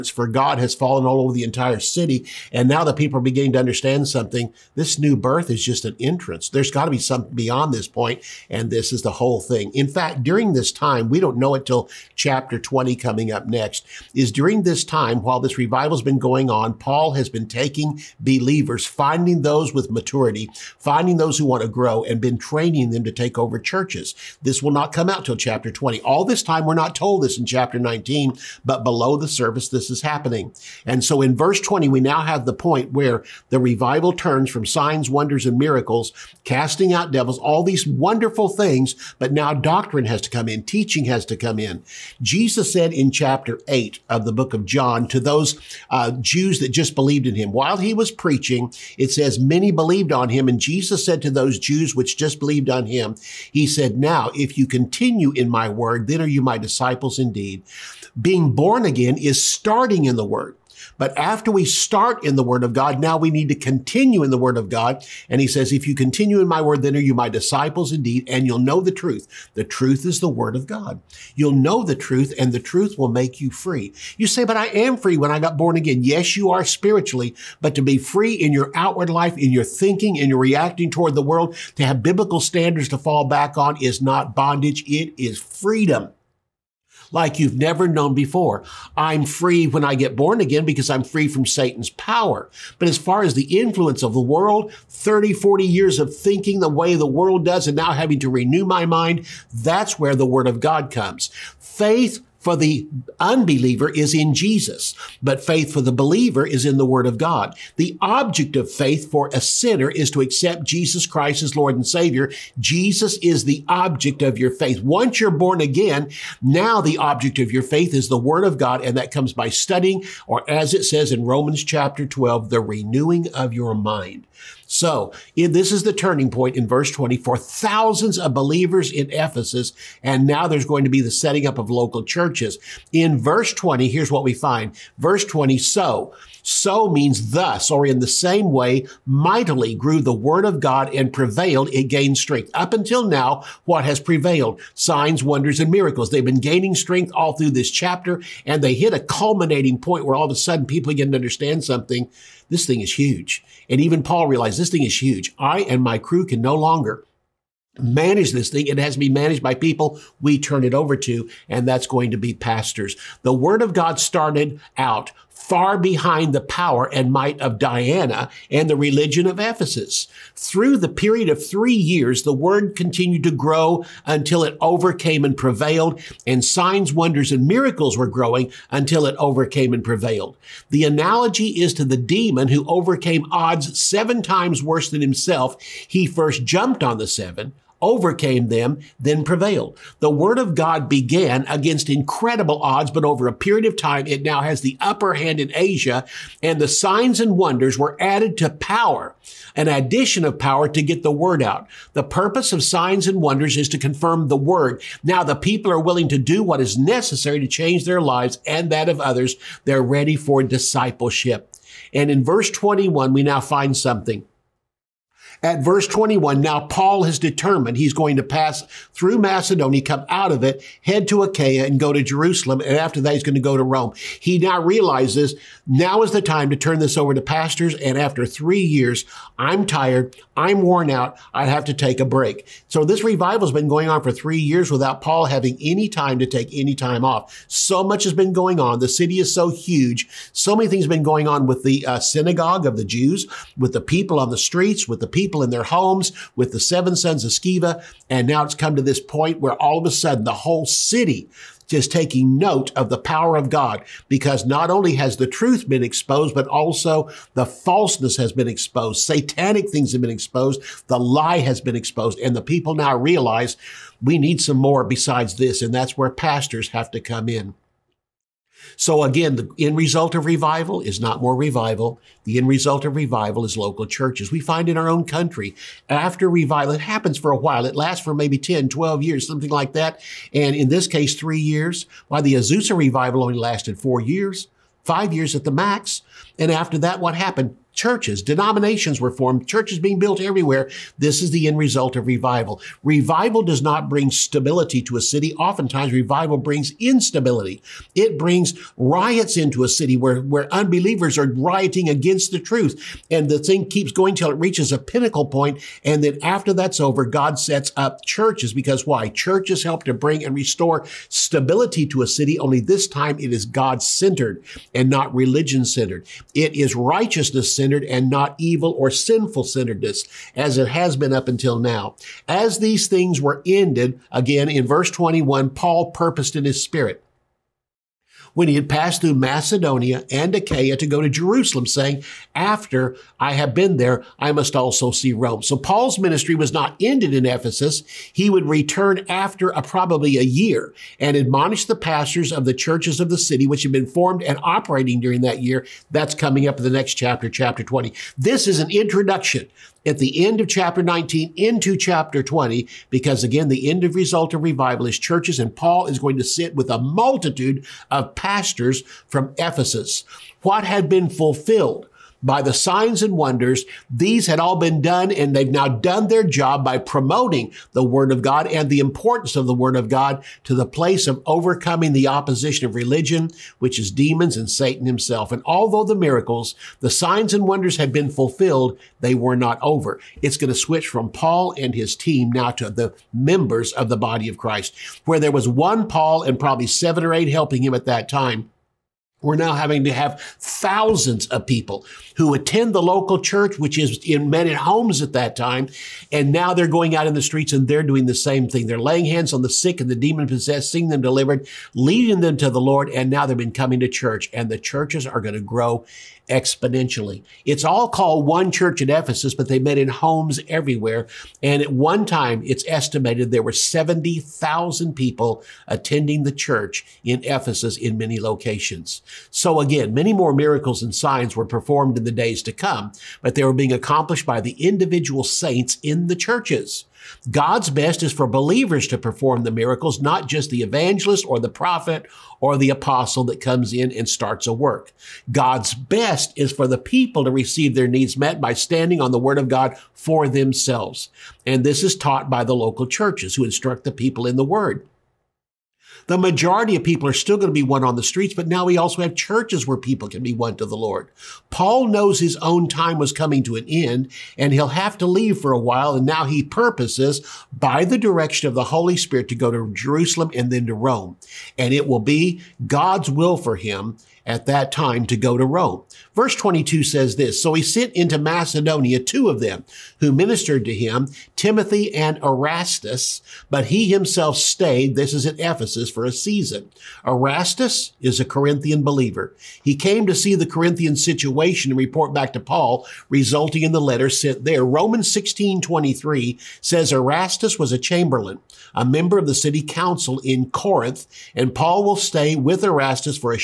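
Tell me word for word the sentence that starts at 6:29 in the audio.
We're now having to have thousands of people who attend the local church, which is in men at homes at that time.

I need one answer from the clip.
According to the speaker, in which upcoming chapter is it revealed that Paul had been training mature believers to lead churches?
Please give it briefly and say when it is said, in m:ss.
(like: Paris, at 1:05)
Chapter 20, at 0:12.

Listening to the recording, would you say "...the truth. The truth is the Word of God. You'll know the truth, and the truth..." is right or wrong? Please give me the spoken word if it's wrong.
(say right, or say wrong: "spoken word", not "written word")
right.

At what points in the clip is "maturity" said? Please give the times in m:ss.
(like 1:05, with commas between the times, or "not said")
0:19.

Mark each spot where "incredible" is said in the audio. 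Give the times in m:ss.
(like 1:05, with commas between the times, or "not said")
3:11.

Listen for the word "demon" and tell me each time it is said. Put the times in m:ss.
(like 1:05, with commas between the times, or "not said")
3:01, 6:13, 6:39.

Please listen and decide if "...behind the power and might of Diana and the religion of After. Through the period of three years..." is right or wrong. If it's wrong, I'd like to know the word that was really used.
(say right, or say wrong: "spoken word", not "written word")
wrong: "Ephesus", not "After".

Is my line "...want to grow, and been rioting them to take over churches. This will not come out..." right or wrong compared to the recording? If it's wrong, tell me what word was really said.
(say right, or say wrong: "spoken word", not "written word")
wrong: "training", not "rioting".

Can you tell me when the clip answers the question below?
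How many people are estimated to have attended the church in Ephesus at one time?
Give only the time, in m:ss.
6:53.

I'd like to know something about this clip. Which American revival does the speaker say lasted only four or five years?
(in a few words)
Azusa.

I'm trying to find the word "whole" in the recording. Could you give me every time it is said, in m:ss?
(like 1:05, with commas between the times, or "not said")
0:09, 4:10.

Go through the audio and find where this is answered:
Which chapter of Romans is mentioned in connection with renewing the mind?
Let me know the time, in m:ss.
2:01.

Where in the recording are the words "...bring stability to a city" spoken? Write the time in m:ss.
4:53.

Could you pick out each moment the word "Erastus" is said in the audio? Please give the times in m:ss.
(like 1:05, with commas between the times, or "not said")
7:52, 7:57, 8:06, 8:12.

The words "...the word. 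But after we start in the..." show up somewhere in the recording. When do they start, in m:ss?
1:00.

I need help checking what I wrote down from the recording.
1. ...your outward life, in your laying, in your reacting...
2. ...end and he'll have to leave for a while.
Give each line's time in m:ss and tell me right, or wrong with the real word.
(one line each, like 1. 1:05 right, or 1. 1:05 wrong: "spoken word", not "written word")
1. 1:18 wrong: "thinking", not "laying"
2. 7:33 right.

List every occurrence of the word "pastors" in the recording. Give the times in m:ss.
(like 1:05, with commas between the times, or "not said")
2:42, 3:47, 4:26, 5:41, 5:58.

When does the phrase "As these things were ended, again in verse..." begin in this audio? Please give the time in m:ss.
5:22.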